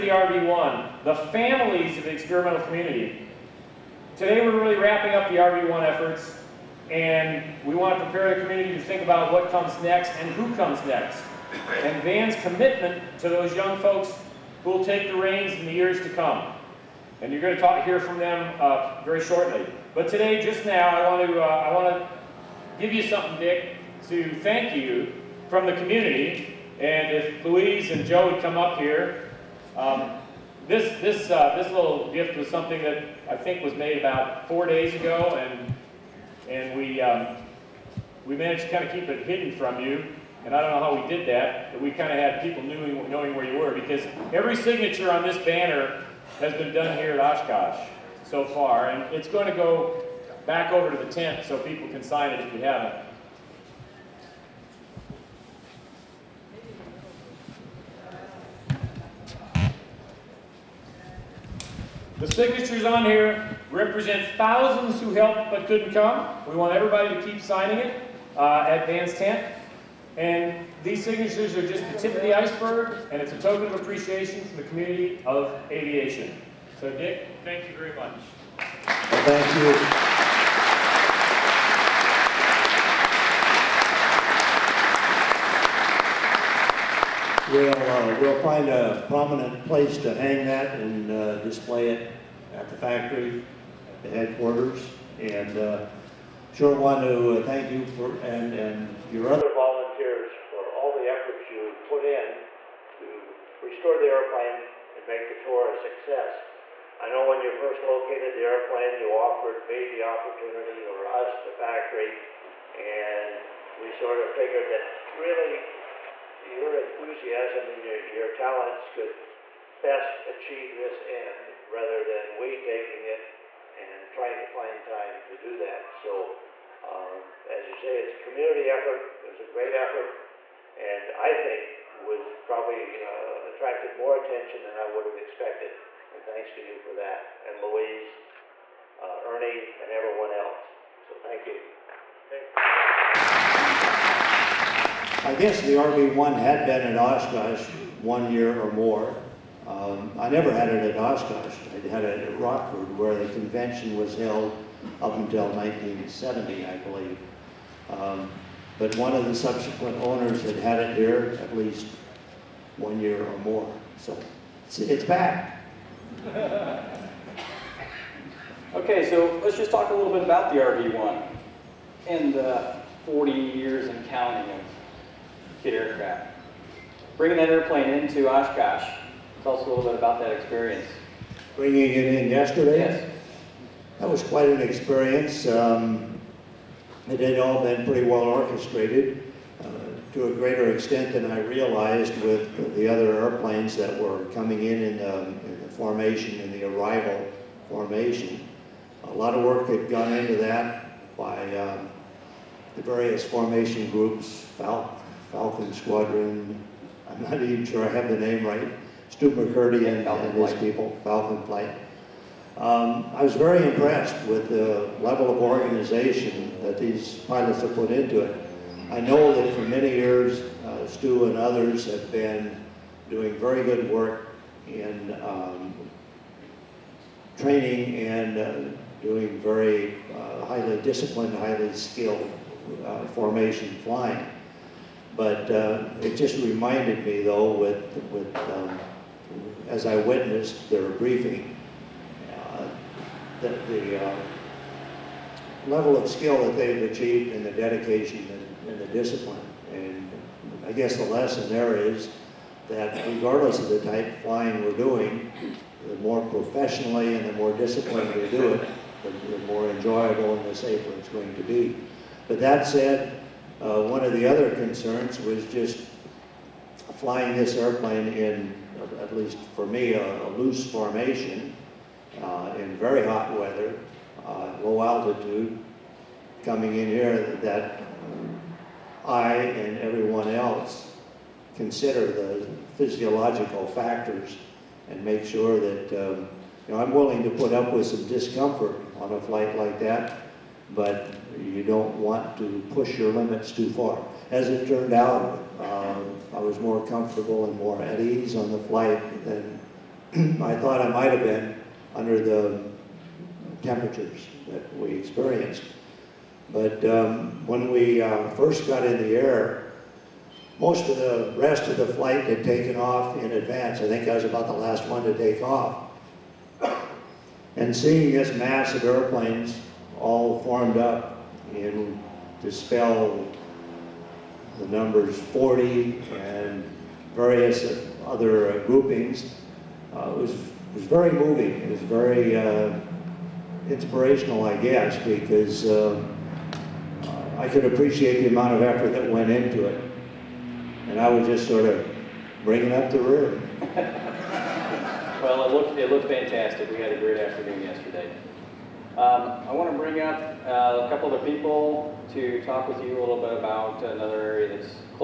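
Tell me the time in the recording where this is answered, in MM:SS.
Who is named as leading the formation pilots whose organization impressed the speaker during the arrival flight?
03:29.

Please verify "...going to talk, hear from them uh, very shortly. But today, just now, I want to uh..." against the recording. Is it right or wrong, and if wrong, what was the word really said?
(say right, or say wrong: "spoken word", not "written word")
right.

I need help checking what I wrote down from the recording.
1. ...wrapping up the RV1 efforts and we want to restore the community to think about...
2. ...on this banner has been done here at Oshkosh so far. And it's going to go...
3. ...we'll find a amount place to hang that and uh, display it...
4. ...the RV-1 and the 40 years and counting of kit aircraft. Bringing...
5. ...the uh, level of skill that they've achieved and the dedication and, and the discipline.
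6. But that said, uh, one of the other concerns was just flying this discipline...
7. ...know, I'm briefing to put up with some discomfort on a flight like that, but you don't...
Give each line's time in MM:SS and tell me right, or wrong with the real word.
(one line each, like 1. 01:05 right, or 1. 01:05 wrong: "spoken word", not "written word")
1. 00:04 wrong: "prepare", not "restore"
2. 00:45 right
3. 01:28 wrong: "prominent", not "amount"
4. 02:50 right
5. 04:03 right
6. 04:22 wrong: "airplane", not "discipline"
7. 04:46 wrong: "willing", not "briefing".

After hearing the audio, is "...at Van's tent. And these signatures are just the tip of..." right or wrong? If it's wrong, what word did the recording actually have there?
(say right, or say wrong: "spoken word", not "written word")
right.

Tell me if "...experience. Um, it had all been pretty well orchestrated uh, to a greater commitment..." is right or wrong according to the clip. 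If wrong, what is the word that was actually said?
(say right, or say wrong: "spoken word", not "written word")
wrong: "extent", not "commitment".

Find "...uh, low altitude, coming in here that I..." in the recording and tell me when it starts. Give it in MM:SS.
04:34.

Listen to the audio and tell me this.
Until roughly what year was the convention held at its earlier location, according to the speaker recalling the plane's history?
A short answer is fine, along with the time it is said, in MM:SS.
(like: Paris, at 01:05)
1970, at 02:35.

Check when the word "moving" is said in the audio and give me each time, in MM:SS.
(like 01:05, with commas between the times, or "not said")
05:31.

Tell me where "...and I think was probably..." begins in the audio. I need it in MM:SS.
02:10.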